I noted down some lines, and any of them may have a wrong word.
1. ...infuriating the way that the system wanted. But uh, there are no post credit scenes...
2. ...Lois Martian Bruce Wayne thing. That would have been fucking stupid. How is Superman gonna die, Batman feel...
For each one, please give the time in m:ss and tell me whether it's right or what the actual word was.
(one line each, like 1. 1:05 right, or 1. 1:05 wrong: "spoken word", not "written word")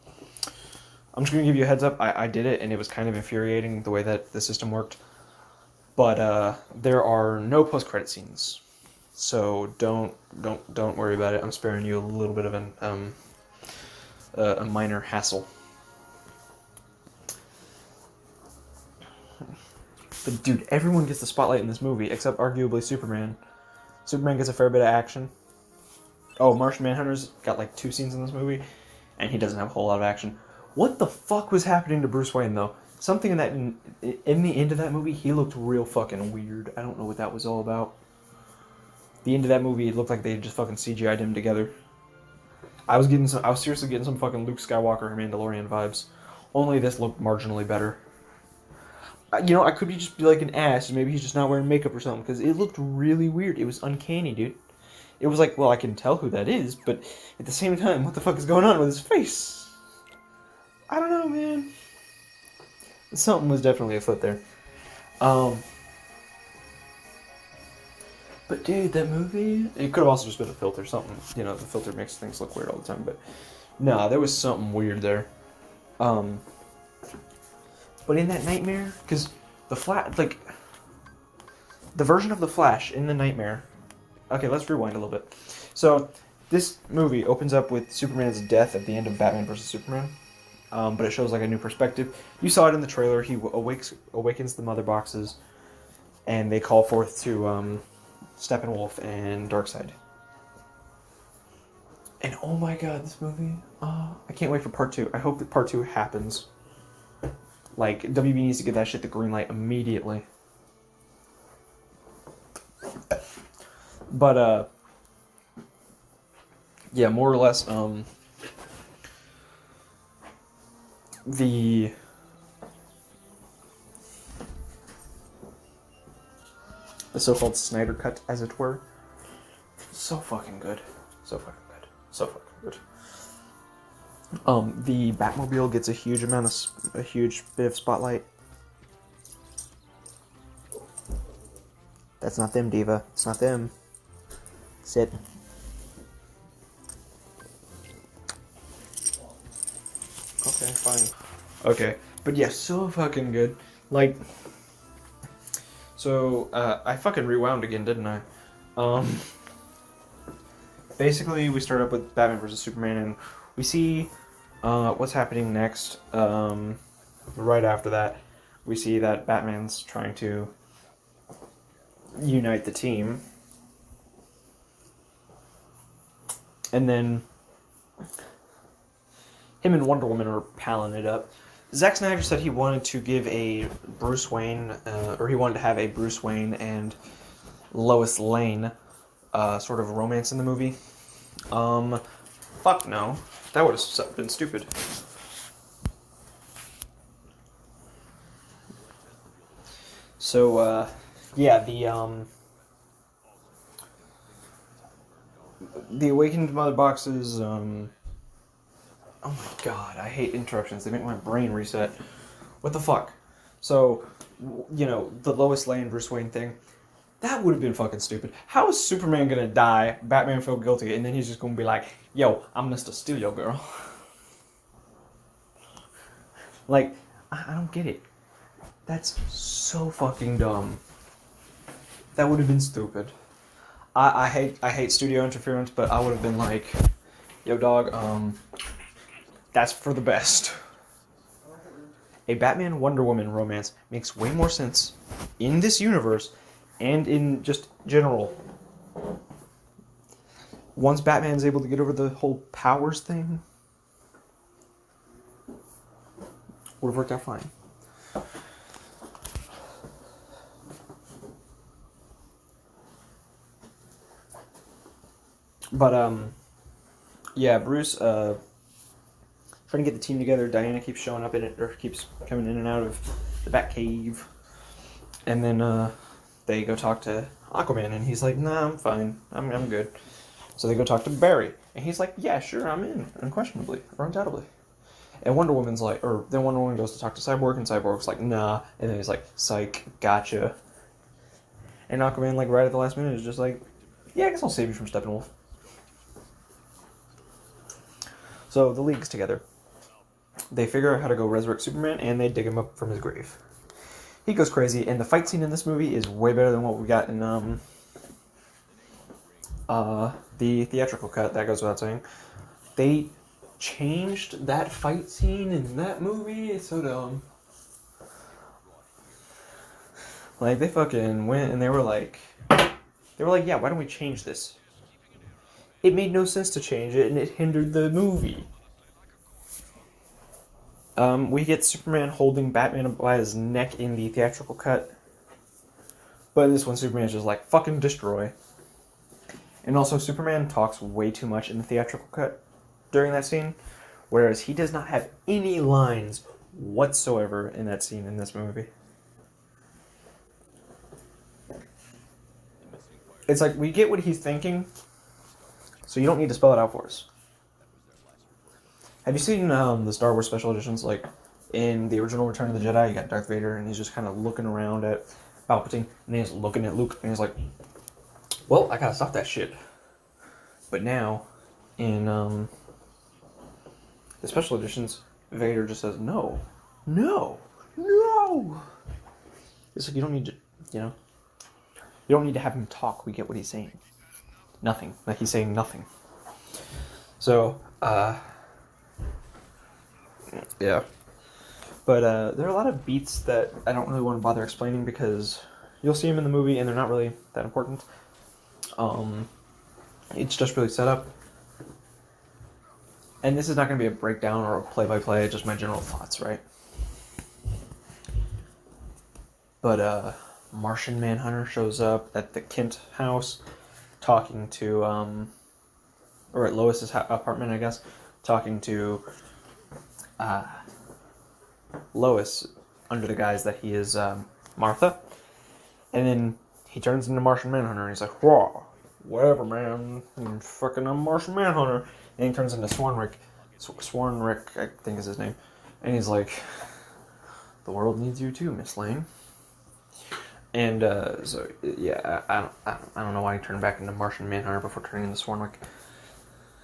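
1. 0:03 wrong: "worked", not "wanted"
2. 3:35 wrong: "Lane", not "Martian".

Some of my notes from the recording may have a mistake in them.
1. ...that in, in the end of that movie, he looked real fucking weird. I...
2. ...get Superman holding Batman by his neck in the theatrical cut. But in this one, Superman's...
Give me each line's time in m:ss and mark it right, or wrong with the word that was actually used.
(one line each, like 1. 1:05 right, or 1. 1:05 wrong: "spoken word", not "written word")
1. 0:33 right
2. 5:31 right.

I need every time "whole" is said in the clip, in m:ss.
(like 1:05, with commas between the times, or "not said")
0:29, 4:12.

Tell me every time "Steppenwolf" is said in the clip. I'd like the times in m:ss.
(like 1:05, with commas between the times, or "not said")
1:38, 4:54.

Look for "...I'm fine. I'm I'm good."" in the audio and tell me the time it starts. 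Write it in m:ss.
4:38.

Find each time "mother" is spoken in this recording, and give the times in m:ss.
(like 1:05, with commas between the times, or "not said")
1:34, 3:26.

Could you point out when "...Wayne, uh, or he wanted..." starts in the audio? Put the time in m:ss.
3:04.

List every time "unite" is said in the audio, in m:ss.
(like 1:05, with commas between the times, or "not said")
2:52.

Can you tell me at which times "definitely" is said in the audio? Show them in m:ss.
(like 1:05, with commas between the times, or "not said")
1:03.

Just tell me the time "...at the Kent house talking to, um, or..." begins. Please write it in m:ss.
6:52.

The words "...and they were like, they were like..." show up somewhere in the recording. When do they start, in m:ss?
5:21.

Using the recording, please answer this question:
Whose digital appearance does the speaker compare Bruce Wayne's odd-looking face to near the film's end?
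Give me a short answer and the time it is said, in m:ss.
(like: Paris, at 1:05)
Luke Skywalker, at 0:44.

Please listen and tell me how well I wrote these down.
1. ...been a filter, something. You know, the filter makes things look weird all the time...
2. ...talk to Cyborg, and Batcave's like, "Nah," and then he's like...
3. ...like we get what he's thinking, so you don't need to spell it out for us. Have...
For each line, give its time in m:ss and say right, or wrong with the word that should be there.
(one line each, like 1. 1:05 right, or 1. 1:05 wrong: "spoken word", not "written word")
1. 1:10 right
2. 4:46 wrong: "Cyborg", not "Batcave"
3. 5:53 right.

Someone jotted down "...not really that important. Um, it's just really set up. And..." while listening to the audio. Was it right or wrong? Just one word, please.
right.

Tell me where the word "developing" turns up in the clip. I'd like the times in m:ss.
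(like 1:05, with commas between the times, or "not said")
not said.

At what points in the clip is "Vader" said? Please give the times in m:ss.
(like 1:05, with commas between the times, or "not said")
6:03, 6:15.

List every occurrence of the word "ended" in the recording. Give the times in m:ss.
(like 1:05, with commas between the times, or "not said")
not said.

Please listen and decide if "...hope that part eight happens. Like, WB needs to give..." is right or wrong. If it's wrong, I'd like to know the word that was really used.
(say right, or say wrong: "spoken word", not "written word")
wrong: "two", not "eight".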